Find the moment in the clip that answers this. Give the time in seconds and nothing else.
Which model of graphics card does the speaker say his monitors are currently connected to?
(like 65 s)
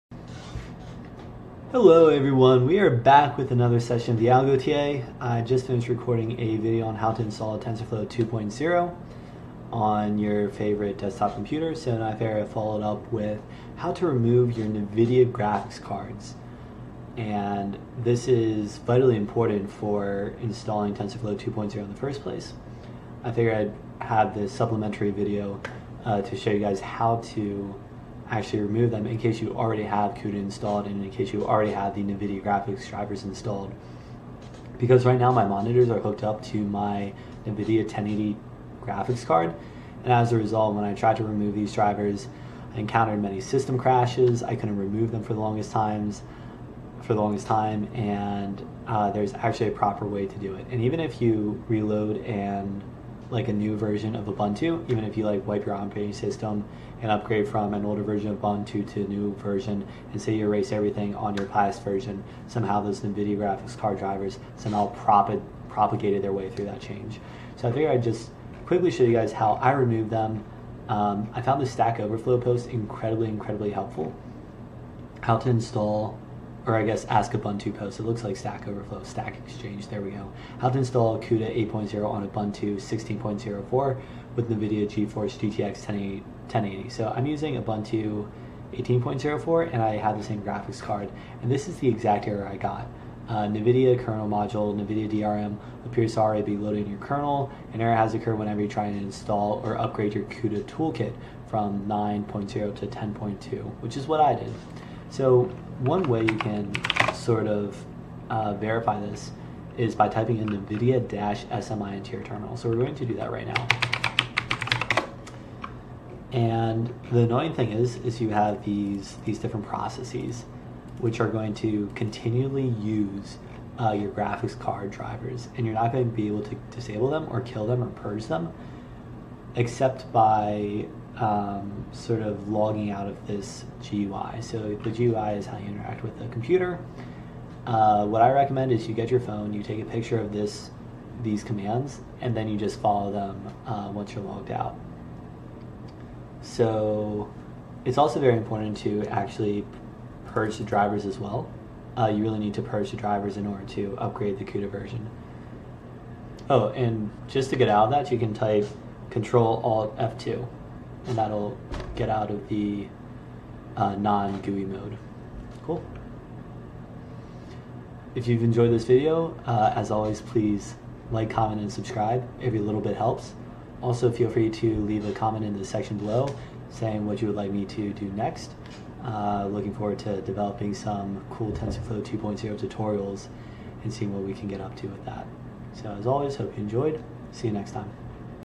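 37 s.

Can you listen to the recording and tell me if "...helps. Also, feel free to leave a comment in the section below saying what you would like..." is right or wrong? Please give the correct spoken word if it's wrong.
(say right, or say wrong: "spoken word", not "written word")
right.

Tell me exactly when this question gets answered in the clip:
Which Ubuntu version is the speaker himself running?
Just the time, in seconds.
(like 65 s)
88 s.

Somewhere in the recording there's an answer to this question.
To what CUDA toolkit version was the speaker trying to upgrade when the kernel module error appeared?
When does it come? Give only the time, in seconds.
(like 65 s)
102 s.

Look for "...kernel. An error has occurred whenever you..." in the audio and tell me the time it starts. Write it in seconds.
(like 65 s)
96 s.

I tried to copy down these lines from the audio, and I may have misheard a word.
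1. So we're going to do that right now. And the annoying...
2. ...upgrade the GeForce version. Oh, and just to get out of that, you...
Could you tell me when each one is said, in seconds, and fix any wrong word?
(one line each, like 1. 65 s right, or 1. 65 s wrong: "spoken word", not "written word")
1. 112 s right
2. 153 s wrong: "CUDA", not "GeForce".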